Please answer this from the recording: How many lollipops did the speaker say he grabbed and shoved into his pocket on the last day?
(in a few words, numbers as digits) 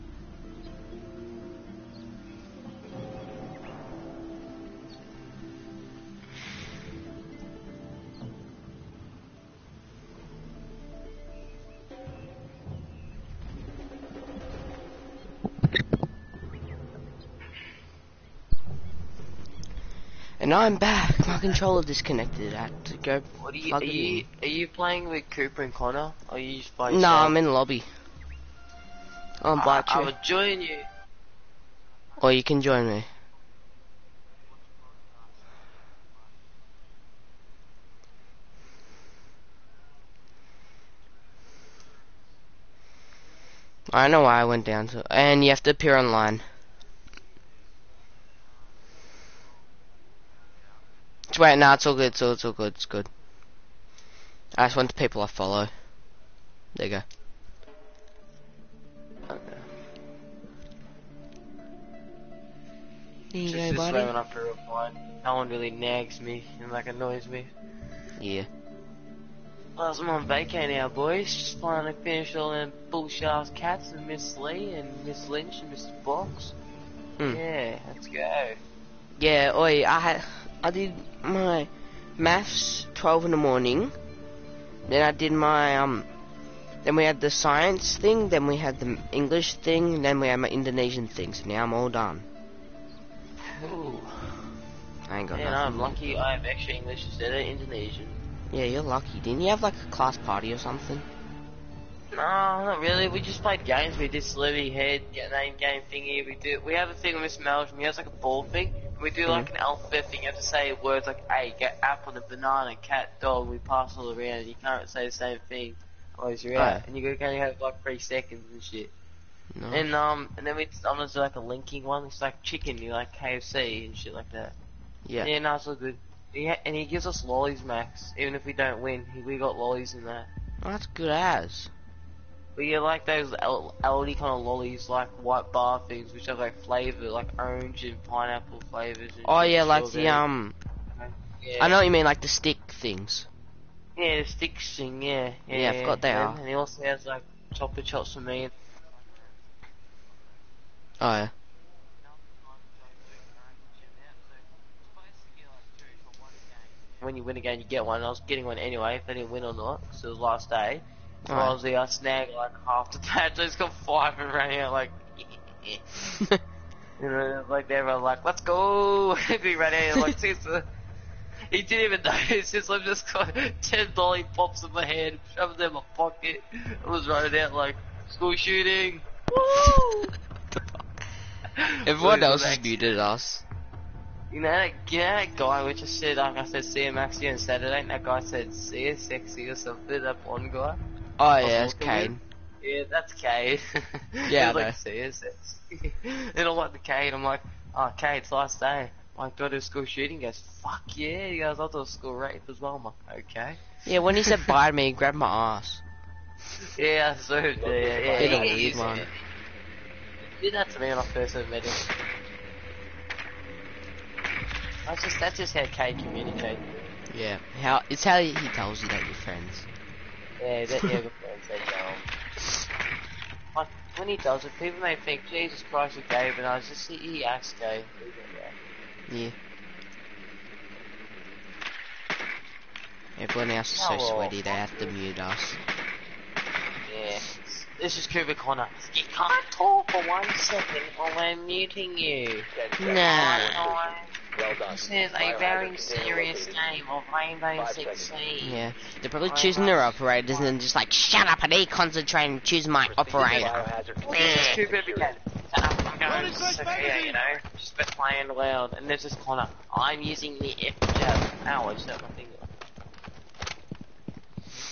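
10.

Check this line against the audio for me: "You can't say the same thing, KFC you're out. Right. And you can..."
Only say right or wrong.
wrong.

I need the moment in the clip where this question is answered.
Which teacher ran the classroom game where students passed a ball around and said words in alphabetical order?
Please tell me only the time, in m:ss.
1:47.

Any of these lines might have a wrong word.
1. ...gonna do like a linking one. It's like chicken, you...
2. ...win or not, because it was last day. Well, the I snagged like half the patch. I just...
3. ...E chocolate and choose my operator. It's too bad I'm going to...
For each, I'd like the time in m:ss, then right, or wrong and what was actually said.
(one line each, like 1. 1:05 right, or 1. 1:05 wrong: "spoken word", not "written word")
1. 2:00 right
2. 2:39 right
3. 4:11 wrong: "concentrate", not "chocolate".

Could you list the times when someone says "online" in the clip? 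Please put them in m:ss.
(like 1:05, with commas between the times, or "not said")
0:45.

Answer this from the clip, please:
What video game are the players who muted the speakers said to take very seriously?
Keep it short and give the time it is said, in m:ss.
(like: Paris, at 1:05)
Rainbow Six Siege, at 4:07.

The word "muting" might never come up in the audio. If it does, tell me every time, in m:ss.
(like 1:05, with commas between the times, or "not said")
4:01.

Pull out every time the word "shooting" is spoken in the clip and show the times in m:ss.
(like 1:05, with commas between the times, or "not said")
2:58, 3:19.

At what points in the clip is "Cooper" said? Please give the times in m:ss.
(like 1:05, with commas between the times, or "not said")
0:25, 3:58.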